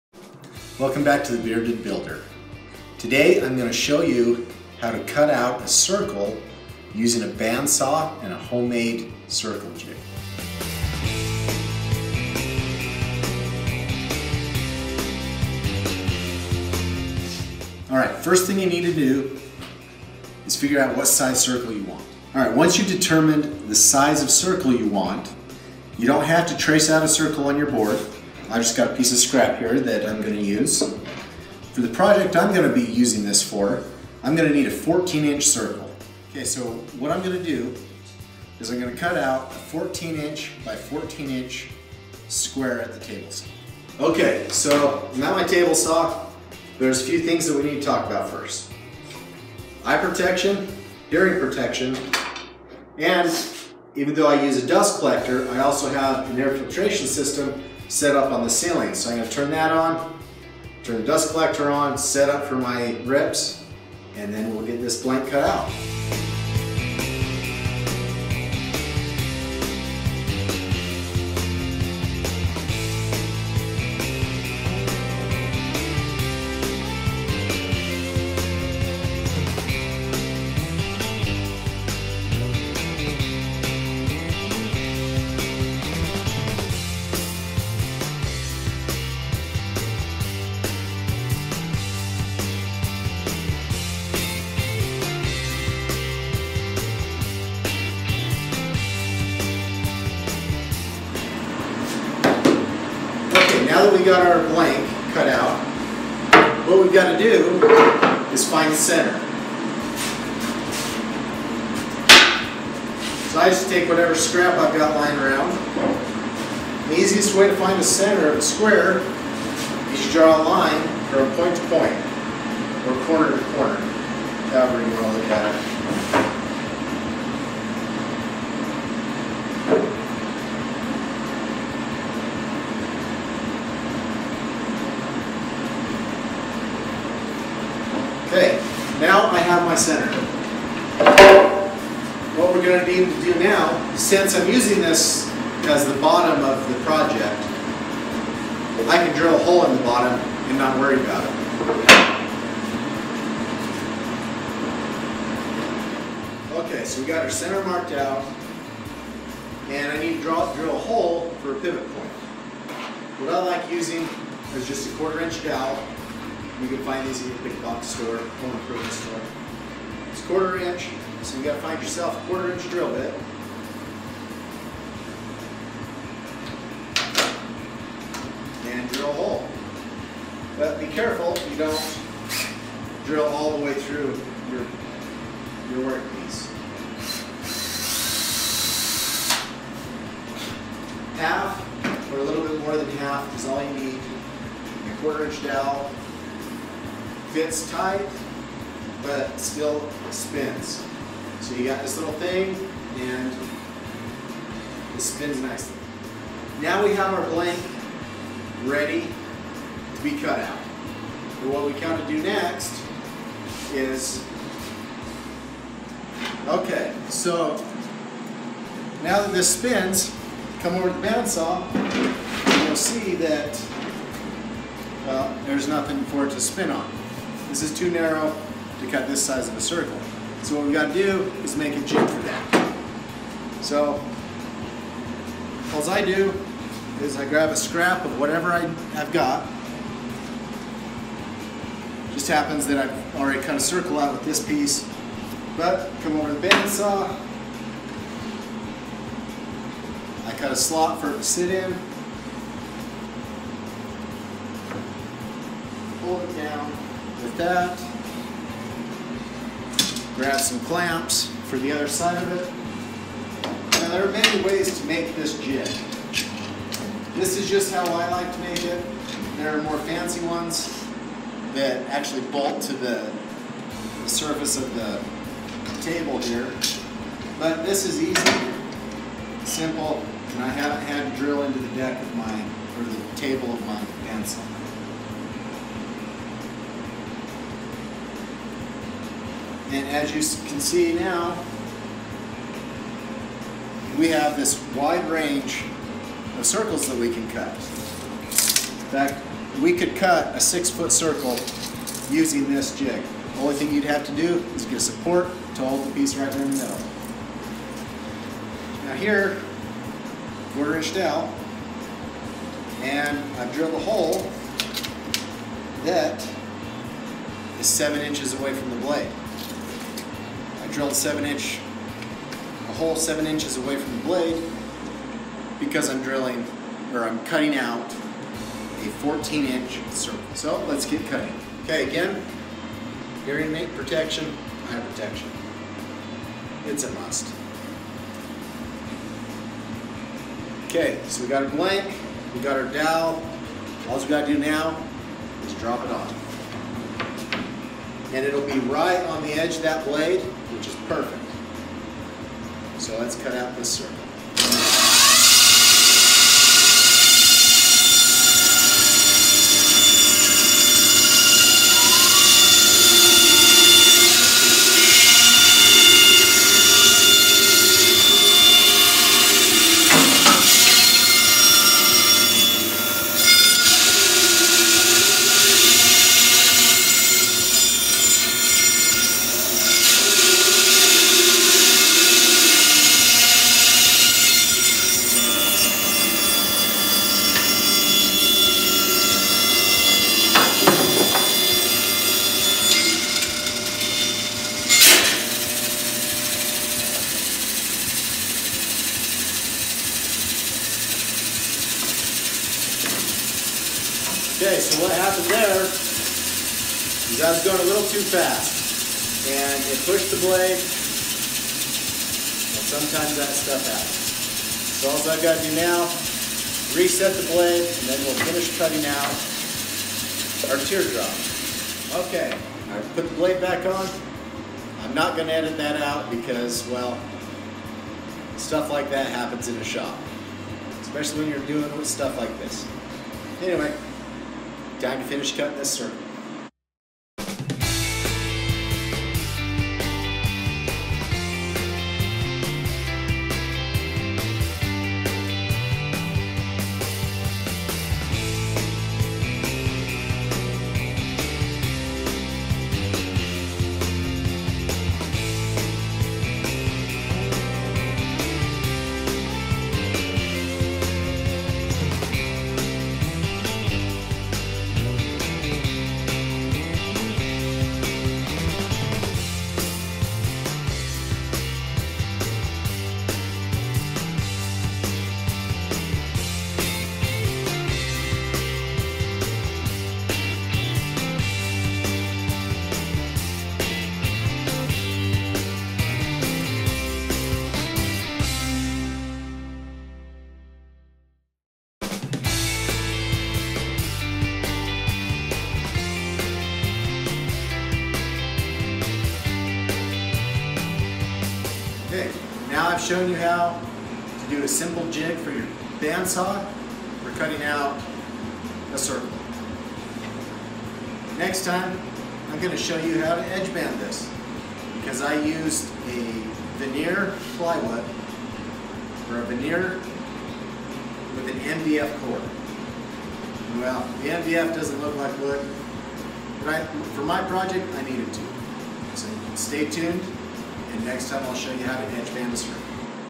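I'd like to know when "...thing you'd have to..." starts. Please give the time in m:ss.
5:03.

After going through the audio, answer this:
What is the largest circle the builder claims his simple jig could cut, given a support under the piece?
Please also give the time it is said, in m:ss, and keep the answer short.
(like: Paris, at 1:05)
6 foot, at 5:00.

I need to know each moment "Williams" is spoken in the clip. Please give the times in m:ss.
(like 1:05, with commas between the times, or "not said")
not said.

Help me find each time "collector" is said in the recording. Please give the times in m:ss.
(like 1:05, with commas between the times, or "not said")
0:54, 1:01.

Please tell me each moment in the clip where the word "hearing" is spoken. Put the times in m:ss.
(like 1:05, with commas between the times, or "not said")
0:51, 5:33.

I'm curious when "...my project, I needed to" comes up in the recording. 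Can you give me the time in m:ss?
8:47.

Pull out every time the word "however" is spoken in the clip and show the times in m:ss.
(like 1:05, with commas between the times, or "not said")
2:04.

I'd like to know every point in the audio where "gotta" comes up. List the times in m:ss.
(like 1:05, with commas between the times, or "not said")
2:51, 3:50, 5:44.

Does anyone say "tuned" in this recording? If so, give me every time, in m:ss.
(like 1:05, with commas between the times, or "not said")
8:49.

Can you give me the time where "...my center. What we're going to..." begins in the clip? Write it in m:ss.
2:19.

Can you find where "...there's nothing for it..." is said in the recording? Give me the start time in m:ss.
3:45.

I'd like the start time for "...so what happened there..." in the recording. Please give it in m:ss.
6:44.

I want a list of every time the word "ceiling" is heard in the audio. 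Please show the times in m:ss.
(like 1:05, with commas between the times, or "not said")
0:58.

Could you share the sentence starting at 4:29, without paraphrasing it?
There are more fancy ones that actually bolt to the, the surface of the table here.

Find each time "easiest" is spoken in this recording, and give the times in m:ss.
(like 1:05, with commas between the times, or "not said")
1:56.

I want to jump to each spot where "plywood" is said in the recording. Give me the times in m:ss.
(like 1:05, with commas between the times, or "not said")
8:37.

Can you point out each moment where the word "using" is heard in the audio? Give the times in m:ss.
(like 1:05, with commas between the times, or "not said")
0:06, 0:32, 2:24, 2:43, 5:02.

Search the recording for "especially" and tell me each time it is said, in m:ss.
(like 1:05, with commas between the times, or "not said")
7:10.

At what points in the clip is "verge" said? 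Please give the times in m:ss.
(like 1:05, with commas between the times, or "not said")
not said.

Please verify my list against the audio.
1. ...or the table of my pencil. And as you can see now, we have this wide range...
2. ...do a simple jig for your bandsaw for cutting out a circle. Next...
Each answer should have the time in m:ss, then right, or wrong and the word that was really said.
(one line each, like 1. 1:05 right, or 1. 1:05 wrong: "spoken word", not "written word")
1. 4:42 right
2. 8:24 right.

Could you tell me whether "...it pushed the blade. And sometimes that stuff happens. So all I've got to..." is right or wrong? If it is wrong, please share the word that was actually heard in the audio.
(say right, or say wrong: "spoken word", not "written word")
right.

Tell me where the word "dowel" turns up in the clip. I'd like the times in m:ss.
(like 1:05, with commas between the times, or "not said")
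2:45, 3:15, 5:42.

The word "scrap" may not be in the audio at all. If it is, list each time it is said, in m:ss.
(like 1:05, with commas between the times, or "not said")
0:29, 1:54, 3:57.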